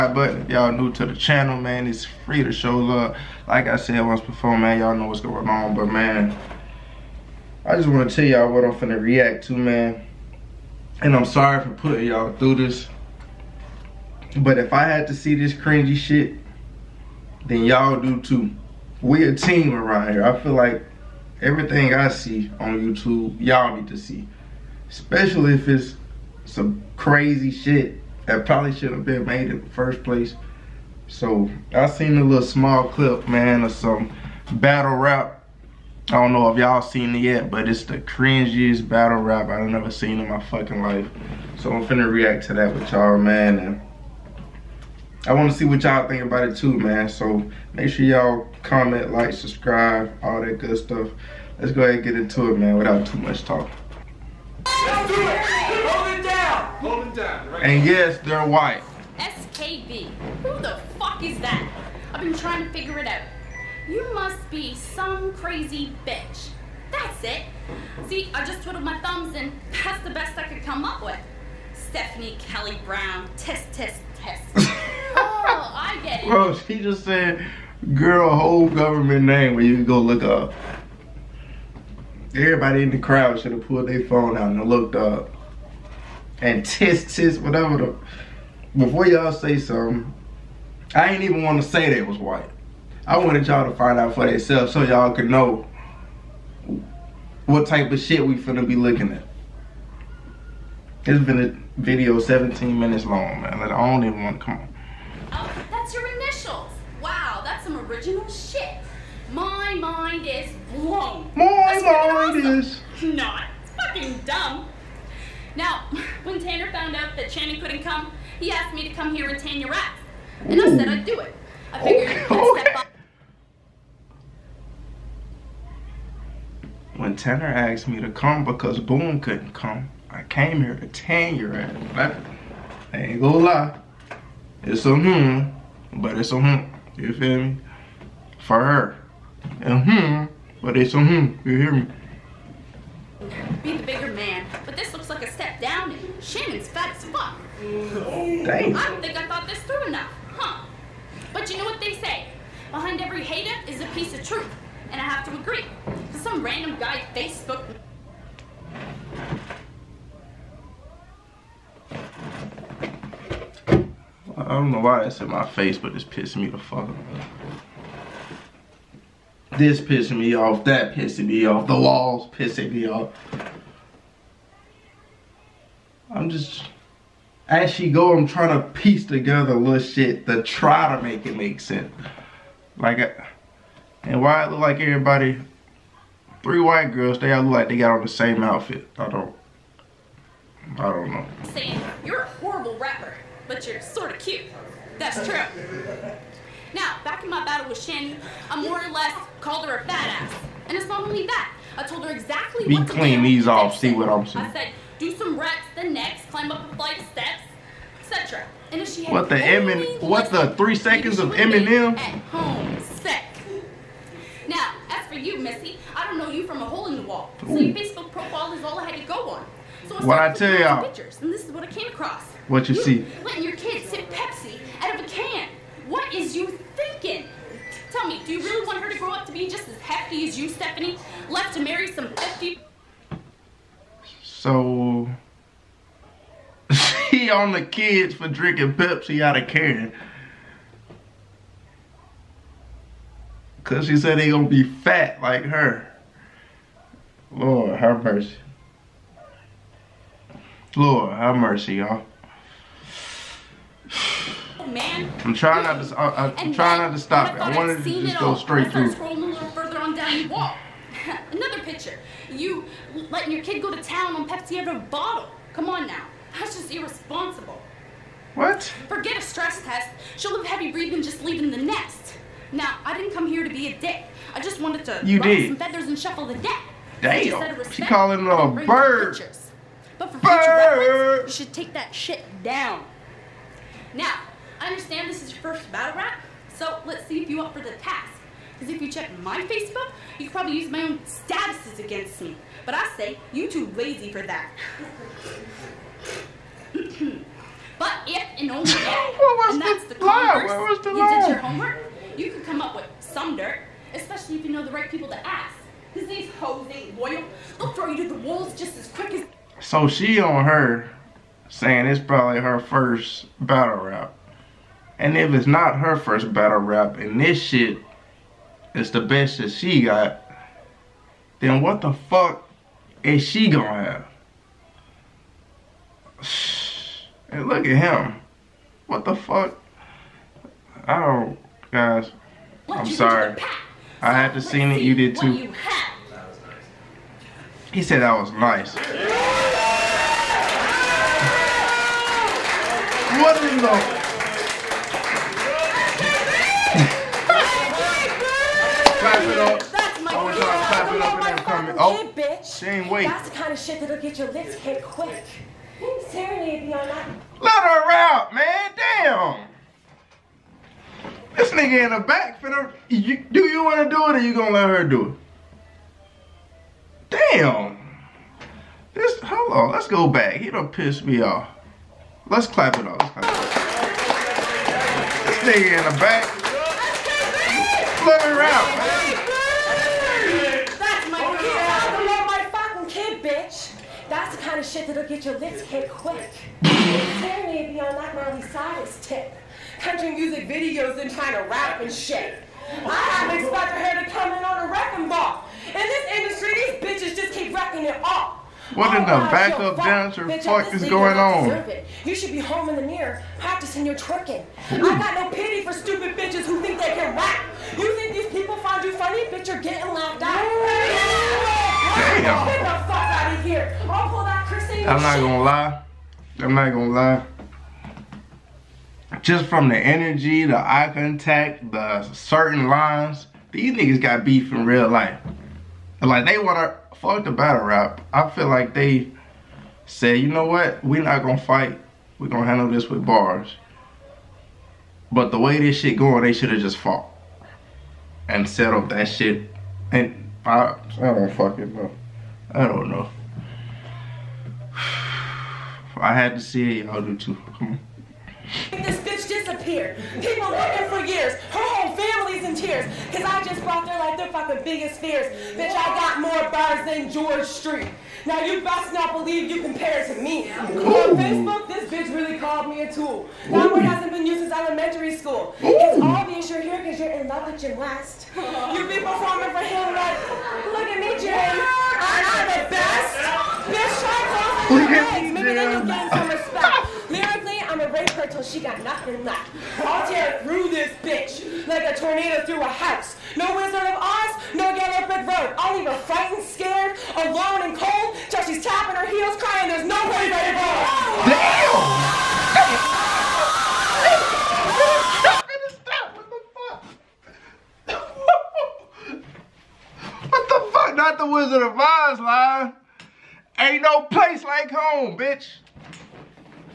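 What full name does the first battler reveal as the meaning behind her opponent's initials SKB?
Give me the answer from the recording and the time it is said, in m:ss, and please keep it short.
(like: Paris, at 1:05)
Stephanie Kelly Brown, at 1:11.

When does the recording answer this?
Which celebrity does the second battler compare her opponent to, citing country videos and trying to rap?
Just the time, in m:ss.
6:28.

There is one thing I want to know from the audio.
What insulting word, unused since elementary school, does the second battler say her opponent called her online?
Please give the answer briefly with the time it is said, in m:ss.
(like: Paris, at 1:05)
tool, at 7:42.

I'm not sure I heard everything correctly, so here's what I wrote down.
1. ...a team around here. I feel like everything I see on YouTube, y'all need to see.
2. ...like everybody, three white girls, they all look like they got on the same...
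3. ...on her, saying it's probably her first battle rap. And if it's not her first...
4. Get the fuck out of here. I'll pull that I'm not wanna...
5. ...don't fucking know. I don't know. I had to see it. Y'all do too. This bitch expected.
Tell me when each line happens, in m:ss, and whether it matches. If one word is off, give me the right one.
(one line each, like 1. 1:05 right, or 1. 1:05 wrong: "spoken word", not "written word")
1. 0:19 right
2. 3:04 right
3. 5:10 right
4. 6:52 wrong: "gonna", not "wanna"
5. 7:21 wrong: "disappeared", not "expected".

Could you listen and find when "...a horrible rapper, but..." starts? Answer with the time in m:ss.
3:12.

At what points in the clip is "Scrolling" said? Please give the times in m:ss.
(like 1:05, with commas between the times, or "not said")
4:18.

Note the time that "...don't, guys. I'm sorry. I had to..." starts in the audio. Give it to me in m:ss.
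5:30.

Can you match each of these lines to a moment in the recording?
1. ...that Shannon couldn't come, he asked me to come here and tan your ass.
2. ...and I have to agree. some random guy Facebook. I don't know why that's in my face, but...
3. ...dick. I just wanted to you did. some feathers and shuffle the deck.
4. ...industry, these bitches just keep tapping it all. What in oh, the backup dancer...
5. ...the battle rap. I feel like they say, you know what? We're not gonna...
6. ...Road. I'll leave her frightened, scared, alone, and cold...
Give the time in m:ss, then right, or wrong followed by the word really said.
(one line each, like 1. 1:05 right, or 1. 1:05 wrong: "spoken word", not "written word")
1. 1:57 right
2. 2:34 right
3. 4:33 right
4. 6:36 wrong: "wrecking", not "tapping"
5. 7:07 right
6. 8:05 right.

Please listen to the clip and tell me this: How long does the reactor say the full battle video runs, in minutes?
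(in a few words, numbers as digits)
17 minutes.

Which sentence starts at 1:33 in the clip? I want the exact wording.
I wanted y'all to find out for themselves so y'all could know what type of shit we finna be looking at.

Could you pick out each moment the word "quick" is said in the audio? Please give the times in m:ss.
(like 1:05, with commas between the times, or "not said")
5:08, 5:54, 6:25.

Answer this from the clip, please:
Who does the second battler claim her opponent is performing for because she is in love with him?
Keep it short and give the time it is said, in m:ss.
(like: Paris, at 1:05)
Jim West, at 7:47.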